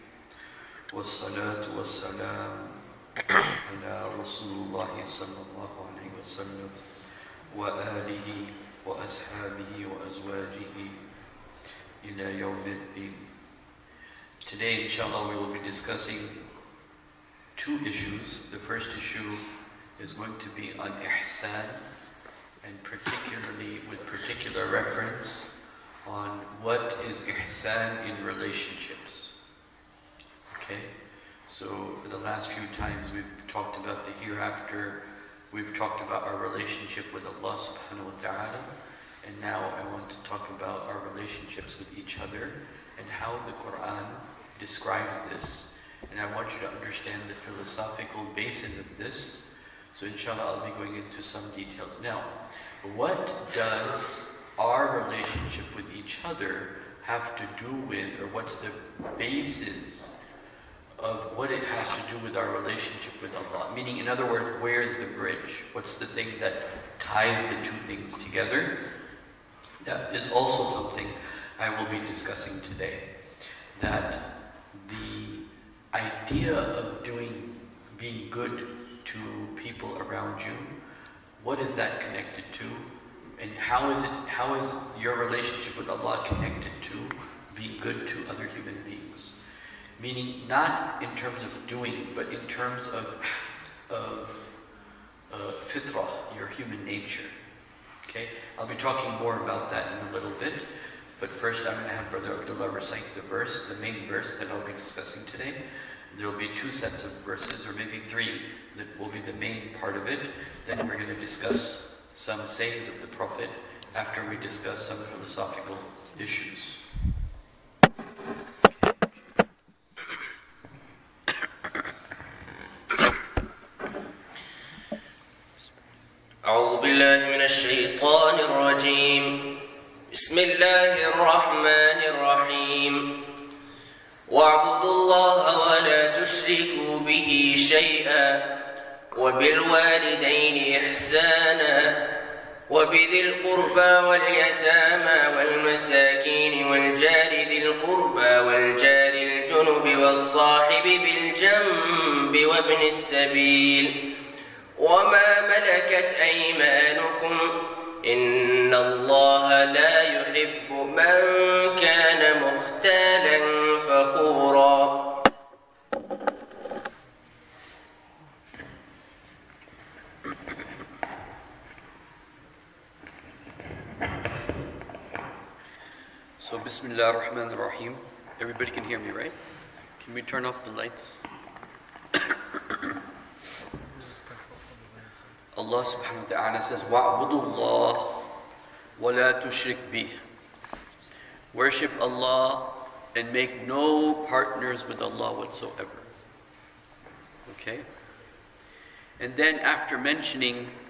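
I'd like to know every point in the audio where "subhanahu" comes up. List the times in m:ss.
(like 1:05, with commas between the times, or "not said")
0:37, 3:05.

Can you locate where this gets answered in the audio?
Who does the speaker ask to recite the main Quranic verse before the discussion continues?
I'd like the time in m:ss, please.
1:42.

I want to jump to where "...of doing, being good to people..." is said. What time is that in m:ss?
1:16.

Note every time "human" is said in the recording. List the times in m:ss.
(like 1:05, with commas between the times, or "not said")
1:28, 1:36.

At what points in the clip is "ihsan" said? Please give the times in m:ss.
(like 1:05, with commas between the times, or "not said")
0:20, 0:27.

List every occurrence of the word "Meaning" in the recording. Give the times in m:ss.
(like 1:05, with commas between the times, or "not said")
1:03, 1:30.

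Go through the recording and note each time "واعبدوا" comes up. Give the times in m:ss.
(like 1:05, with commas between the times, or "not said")
2:14, 3:06.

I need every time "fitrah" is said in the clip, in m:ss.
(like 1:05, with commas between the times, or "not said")
1:35.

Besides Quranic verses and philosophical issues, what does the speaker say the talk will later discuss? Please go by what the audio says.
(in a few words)
sayings of the Prophet.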